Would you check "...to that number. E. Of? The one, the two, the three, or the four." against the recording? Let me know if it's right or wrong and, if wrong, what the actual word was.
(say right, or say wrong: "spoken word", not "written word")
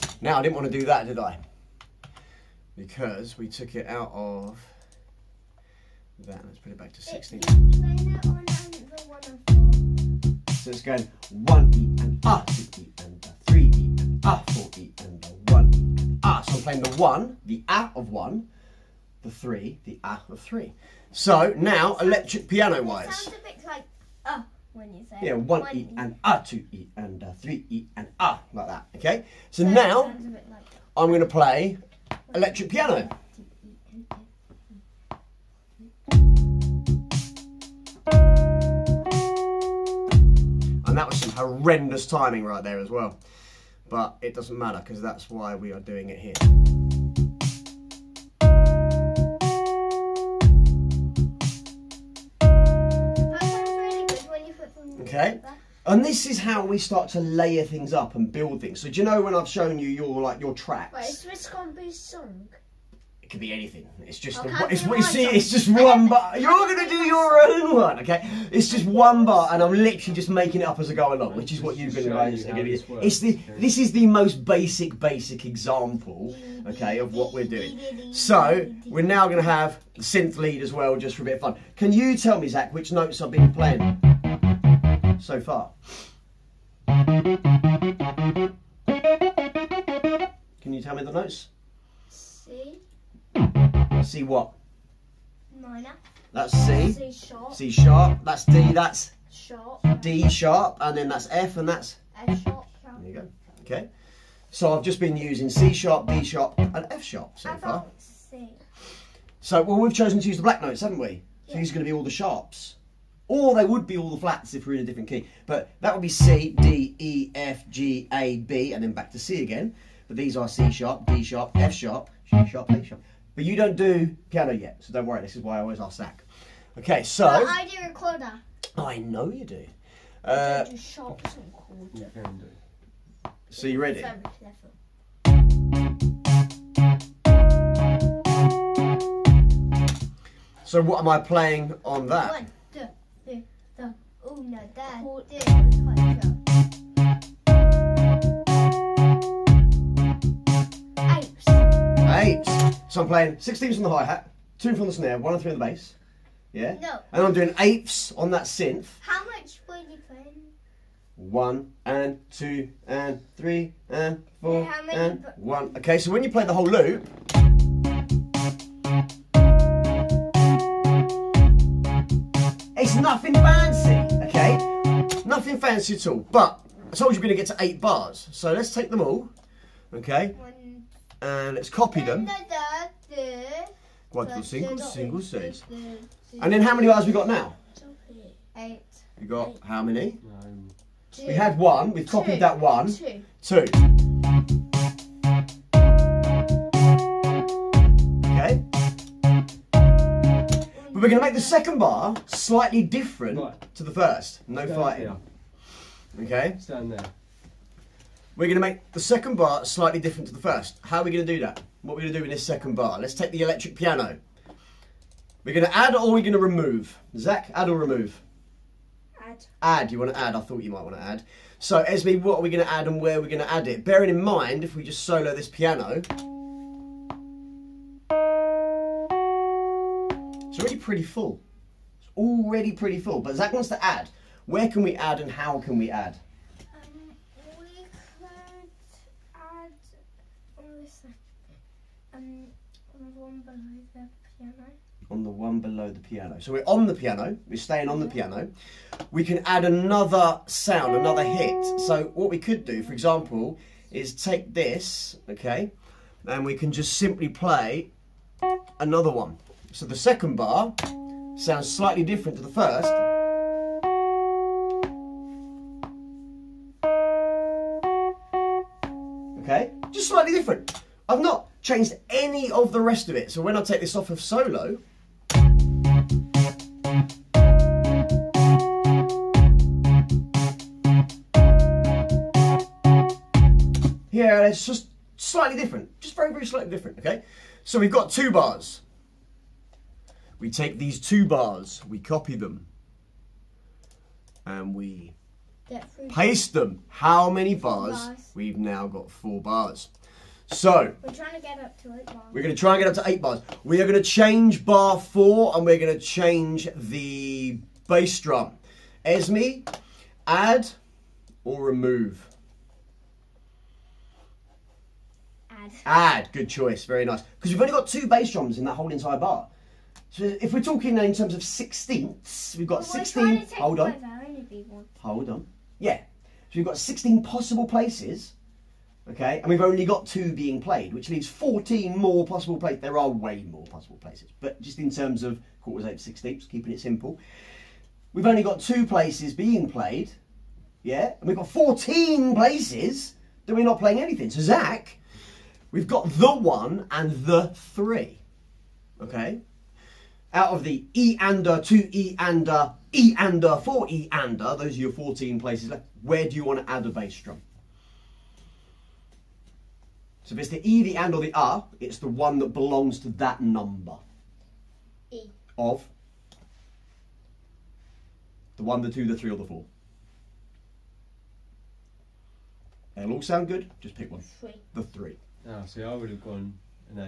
right.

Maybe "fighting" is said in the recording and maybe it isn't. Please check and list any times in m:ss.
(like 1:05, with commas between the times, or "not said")
3:24.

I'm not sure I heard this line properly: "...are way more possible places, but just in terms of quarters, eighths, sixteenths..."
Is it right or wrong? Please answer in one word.
right.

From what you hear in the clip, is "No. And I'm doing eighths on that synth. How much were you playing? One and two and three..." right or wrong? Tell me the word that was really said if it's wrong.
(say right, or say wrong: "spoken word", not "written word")
right.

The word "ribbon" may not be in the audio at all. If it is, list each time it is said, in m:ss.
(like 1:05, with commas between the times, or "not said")
not said.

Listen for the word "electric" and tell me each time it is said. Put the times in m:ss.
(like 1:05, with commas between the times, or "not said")
0:22, 0:32, 3:33.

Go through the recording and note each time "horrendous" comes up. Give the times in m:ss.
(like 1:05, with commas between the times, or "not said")
0:41.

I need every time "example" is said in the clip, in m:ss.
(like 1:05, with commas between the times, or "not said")
1:15, 4:12.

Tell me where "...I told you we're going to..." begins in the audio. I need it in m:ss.
2:56.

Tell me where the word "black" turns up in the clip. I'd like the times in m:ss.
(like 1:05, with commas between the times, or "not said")
1:50.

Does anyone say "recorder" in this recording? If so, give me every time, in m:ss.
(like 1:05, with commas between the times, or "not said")
2:07.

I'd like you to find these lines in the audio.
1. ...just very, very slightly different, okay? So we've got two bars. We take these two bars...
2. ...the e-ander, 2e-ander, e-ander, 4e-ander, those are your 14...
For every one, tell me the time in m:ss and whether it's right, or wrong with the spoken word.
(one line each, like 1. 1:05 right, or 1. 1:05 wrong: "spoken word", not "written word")
1. 4:46 right
2. 5:50 right.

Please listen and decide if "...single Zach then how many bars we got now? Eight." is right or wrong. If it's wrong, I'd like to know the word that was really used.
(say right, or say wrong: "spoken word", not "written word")
wrong: "And", not "Zach".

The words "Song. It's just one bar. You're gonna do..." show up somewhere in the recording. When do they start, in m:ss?
1:05.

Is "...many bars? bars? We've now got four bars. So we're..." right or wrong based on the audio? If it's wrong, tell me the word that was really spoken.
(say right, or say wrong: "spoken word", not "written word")
right.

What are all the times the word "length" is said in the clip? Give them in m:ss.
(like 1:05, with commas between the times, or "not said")
not said.